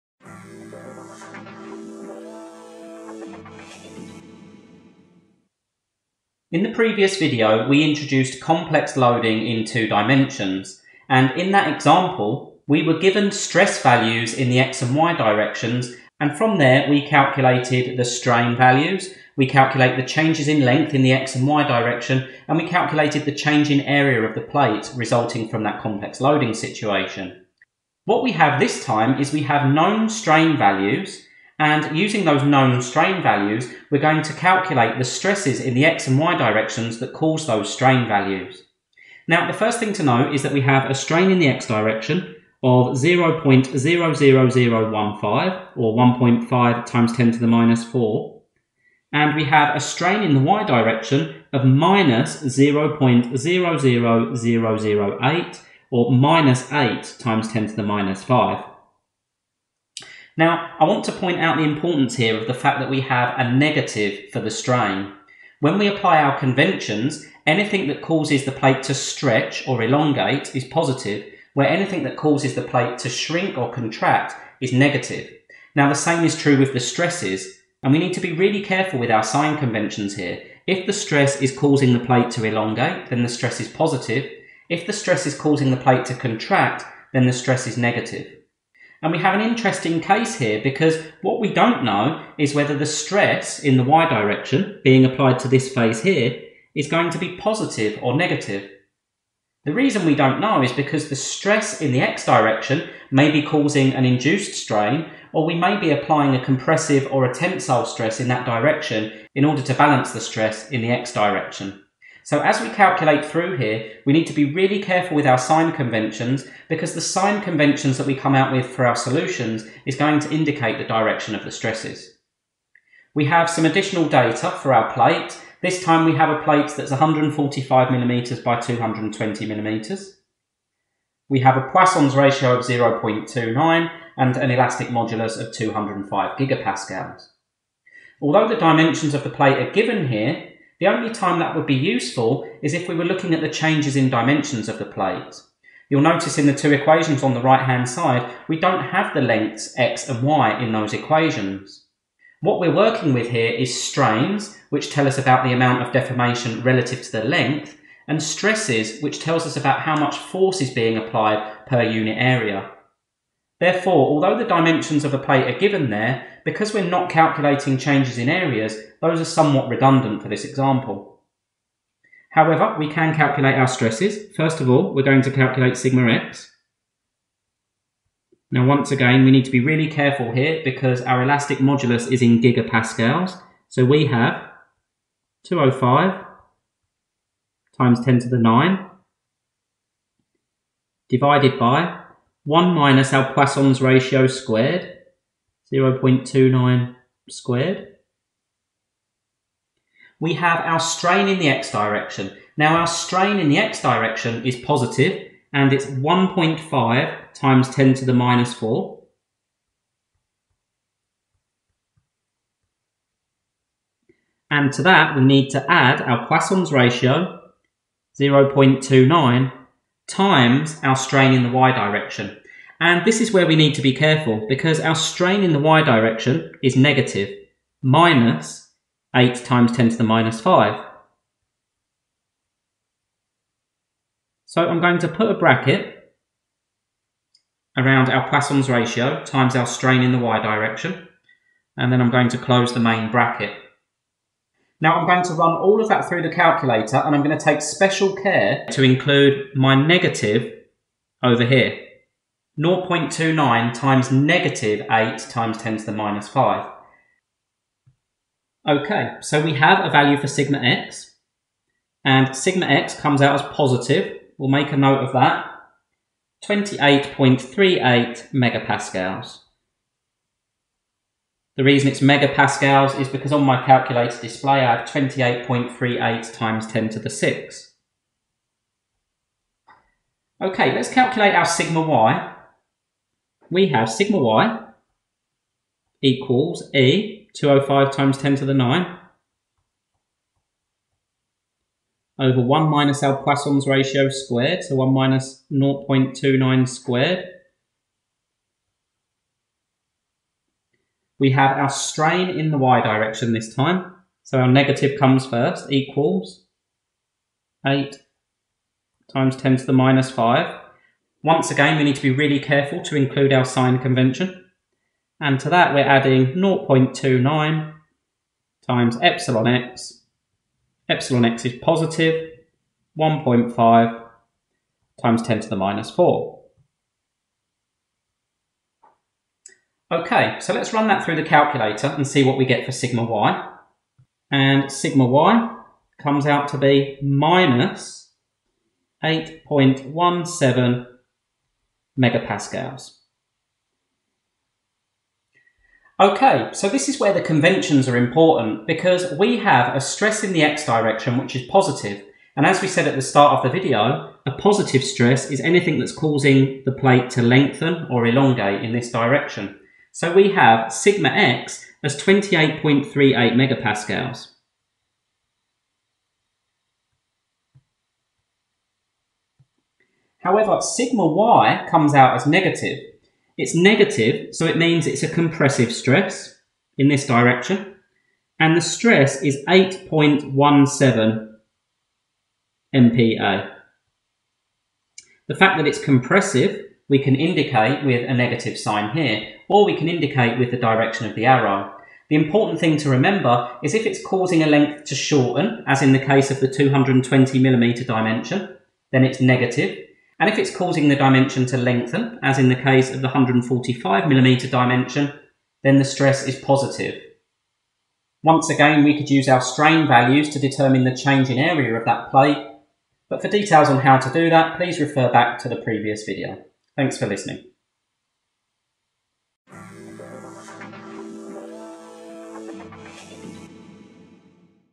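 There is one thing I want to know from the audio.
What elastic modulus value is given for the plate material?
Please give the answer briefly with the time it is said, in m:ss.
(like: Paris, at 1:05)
205 gigapascals, at 2:15.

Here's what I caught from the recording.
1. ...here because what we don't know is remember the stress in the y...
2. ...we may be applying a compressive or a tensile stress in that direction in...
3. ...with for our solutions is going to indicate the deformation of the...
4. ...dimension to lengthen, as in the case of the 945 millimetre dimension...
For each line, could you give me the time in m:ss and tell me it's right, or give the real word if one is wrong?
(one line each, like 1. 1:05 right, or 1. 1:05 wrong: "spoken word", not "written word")
1. 1:30 wrong: "whether", not "remember"
2. 1:45 right
3. 1:58 wrong: "direction", not "deformation"
4. 6:40 wrong: "145", not "945".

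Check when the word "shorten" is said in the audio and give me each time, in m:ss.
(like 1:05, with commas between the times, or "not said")
6:34.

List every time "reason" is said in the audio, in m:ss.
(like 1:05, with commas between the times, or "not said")
1:39, 4:31.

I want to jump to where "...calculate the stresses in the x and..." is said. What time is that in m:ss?
0:34.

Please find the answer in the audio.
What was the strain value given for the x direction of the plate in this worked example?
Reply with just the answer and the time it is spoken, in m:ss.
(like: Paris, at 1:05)
0.00015, at 0:42.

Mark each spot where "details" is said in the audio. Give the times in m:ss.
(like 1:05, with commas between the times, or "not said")
6:53.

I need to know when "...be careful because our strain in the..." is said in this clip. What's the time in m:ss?
3:43.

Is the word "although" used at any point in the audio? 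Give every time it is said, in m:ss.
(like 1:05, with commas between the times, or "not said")
2:18, 2:44.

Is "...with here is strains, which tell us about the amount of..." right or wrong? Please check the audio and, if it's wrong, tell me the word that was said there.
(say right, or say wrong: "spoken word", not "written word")
right.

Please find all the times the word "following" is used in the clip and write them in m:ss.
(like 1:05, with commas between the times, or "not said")
not said.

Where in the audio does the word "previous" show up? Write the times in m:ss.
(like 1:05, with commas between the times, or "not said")
0:06, 6:55.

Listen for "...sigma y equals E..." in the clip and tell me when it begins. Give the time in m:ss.
4:43.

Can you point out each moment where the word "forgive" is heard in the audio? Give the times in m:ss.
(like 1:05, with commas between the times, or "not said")
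not said.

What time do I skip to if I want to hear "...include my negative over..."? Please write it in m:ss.
4:08.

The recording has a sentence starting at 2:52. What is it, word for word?
However, we can calculate our stresses.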